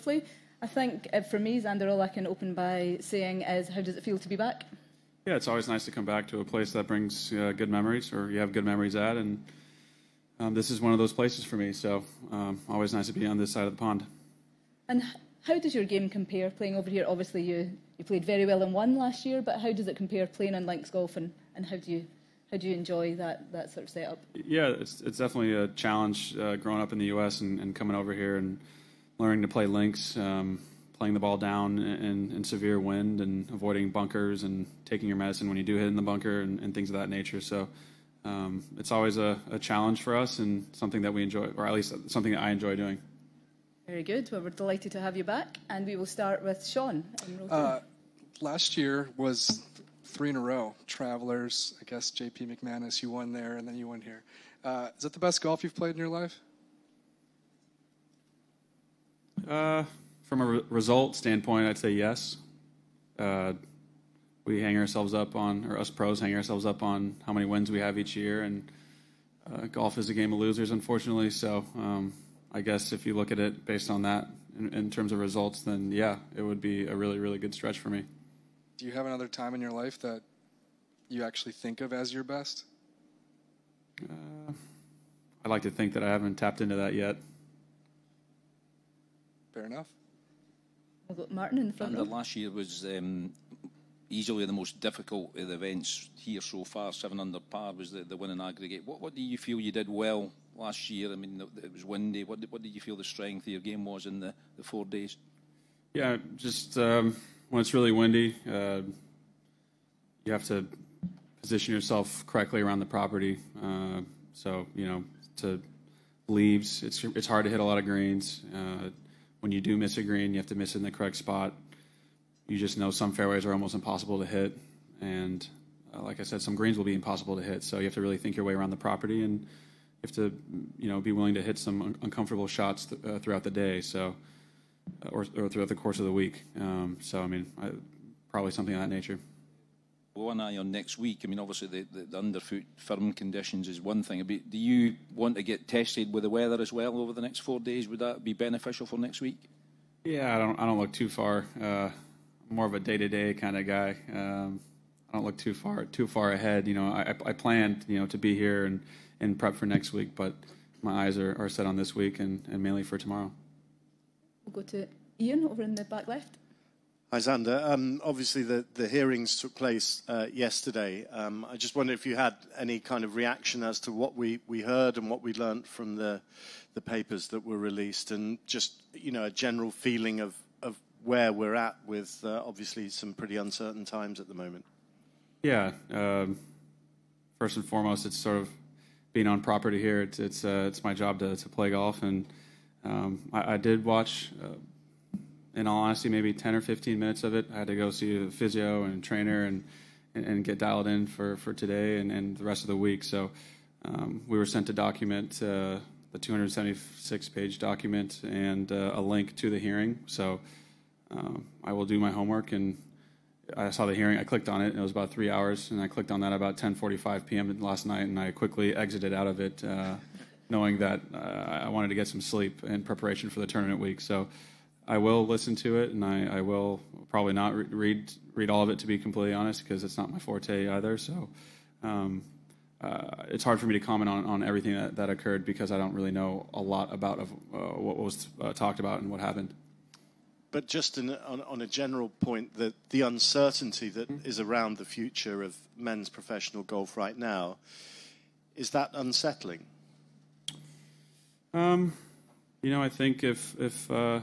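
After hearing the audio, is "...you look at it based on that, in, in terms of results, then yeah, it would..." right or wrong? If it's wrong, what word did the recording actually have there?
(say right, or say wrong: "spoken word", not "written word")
right.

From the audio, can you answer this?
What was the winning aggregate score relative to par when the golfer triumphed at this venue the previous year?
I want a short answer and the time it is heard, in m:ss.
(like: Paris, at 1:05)
7 under par, at 1:36.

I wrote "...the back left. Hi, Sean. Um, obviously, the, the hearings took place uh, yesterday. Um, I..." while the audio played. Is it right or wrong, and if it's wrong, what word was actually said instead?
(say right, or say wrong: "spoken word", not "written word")
wrong: "Xander", not "Sean".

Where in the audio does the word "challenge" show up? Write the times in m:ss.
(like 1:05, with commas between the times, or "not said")
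0:25, 0:39.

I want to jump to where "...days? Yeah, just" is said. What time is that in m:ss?
1:44.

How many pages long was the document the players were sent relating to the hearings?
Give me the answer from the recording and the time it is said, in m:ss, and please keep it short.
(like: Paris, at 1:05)
276, at 3:26.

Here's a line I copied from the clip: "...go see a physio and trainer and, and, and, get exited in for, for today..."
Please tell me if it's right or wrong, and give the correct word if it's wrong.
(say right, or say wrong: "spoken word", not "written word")
wrong: "dialed", not "exited".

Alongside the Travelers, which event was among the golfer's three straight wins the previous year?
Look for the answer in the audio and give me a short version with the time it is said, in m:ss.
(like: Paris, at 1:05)
JP McManus, at 0:52.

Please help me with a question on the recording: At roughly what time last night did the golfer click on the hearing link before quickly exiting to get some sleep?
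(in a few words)
10:45 p.m.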